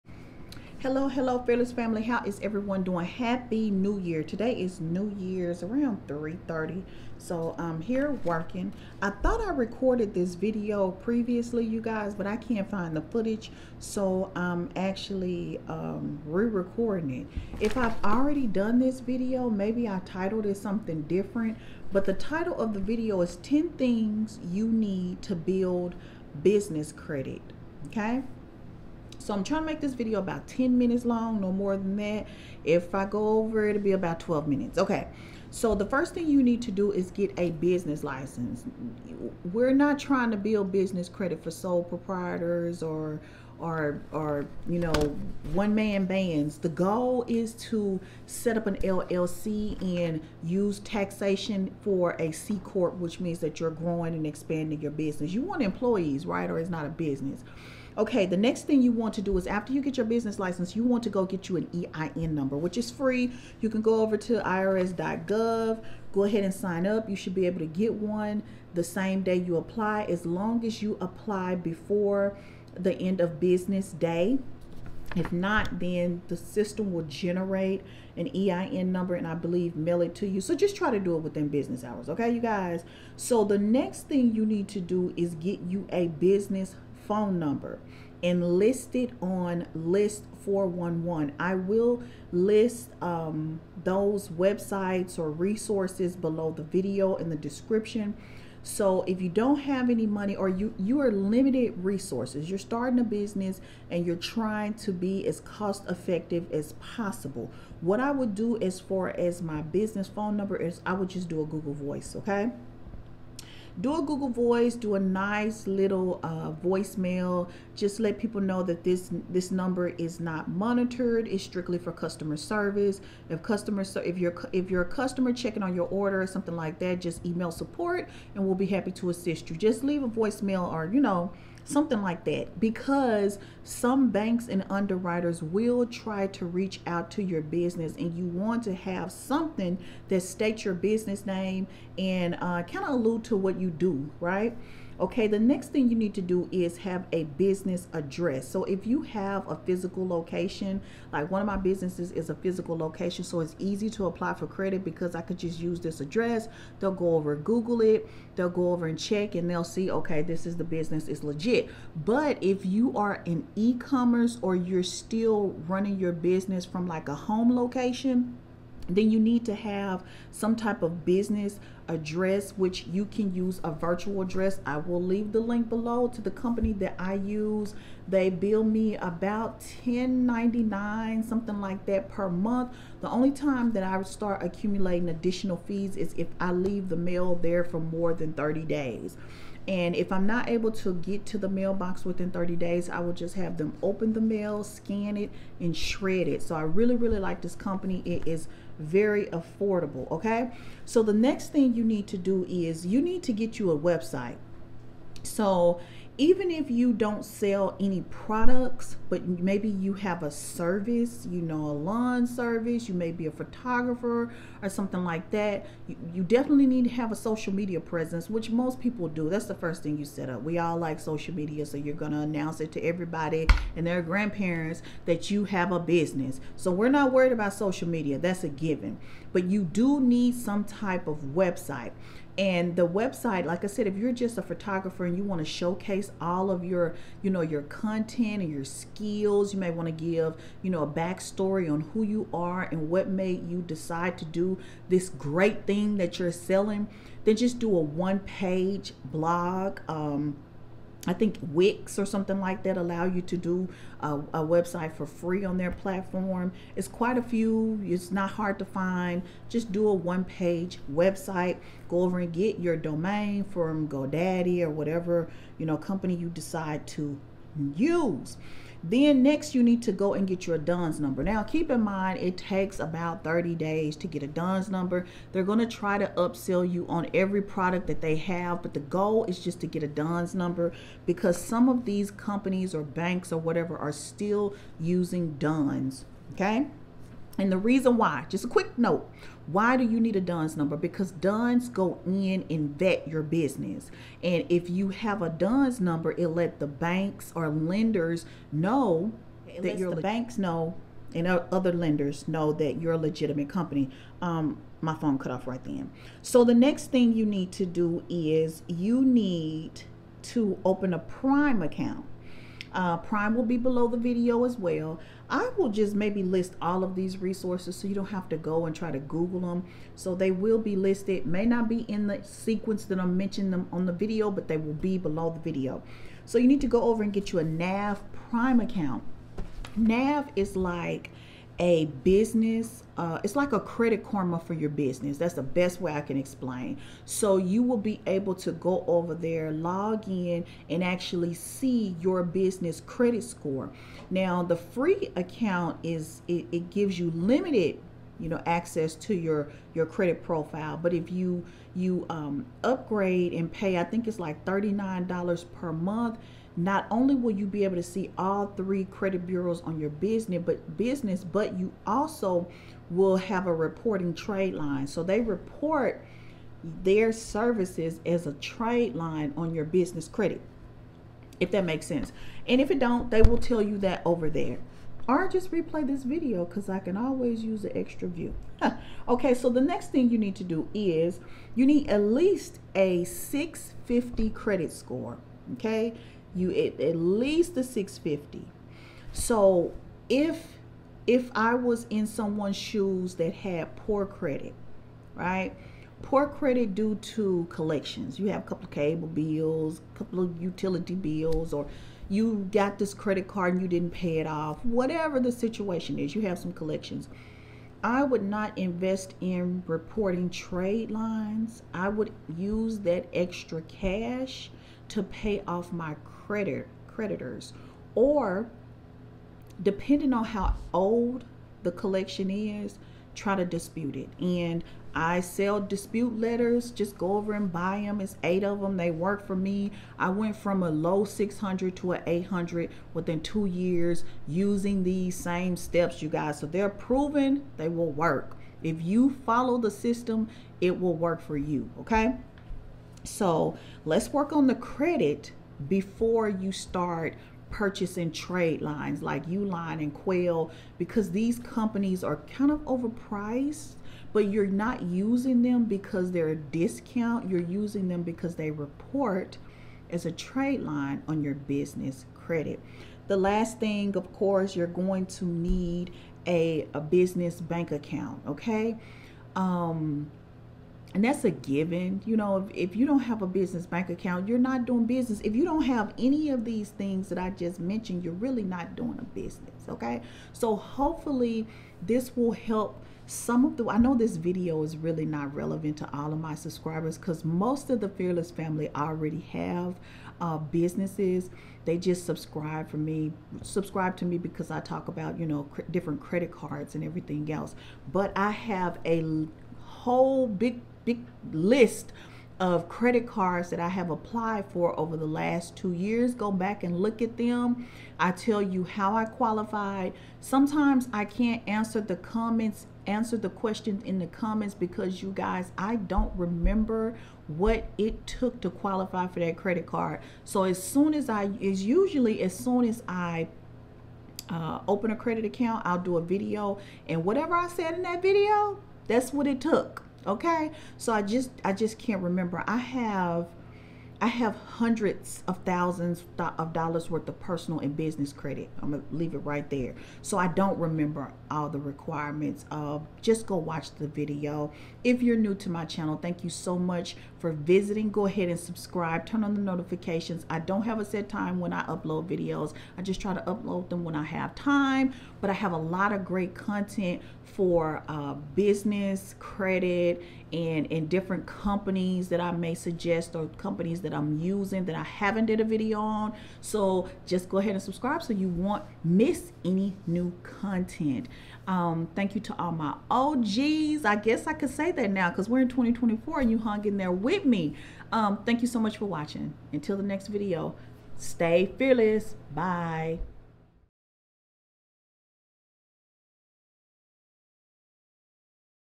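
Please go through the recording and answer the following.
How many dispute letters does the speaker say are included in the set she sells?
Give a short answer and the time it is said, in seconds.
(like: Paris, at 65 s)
8, at 428 s.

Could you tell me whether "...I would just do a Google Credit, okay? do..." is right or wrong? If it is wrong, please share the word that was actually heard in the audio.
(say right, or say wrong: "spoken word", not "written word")
wrong: "Voice", not "Credit".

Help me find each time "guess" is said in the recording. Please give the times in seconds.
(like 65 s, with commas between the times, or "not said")
573 s.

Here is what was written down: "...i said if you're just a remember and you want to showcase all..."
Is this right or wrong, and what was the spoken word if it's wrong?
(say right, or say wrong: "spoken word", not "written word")
wrong: "photographer", not "remember".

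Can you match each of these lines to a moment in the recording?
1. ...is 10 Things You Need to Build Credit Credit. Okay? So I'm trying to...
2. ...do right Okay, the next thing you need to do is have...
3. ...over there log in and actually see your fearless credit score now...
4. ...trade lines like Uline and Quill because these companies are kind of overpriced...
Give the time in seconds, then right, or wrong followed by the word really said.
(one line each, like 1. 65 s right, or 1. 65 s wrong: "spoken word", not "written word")
1. 23 s wrong: "Business", not "Credit"
2. 143 s right
3. 338 s wrong: "business", not "fearless"
4. 448 s right.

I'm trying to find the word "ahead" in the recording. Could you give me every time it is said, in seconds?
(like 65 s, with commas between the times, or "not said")
66 s, 548 s, 567 s.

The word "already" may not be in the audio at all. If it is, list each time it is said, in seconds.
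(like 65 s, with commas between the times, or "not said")
18 s, 488 s.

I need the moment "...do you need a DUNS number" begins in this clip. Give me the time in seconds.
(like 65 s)
289 s.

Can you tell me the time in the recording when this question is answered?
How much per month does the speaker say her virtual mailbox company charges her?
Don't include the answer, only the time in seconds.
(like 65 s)
179 s.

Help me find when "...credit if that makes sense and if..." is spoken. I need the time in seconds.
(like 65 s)
370 s.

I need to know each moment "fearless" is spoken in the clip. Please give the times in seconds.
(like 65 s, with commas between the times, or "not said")
1 s, 487 s, 581 s.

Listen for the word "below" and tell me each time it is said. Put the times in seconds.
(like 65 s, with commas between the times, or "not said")
96 s, 175 s, 313 s, 324 s.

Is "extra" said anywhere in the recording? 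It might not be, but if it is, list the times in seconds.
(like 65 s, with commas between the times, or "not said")
377 s, 413 s.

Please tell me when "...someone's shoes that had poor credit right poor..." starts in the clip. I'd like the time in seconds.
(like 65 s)
392 s.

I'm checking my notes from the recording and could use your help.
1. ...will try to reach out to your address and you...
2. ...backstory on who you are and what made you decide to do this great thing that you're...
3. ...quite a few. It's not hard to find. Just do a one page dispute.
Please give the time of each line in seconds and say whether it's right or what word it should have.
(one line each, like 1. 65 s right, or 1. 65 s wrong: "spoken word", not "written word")
1. 135 s wrong: "business", not "address"
2. 240 s right
3. 256 s wrong: "website", not "dispute".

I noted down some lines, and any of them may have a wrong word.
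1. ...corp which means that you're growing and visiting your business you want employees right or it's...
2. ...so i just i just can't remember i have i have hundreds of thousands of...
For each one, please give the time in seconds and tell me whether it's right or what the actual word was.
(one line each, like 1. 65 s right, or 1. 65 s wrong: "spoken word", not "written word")
1. 52 s wrong: "expanding", not "visiting"
2. 530 s right.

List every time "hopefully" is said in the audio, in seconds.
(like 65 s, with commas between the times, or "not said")
480 s.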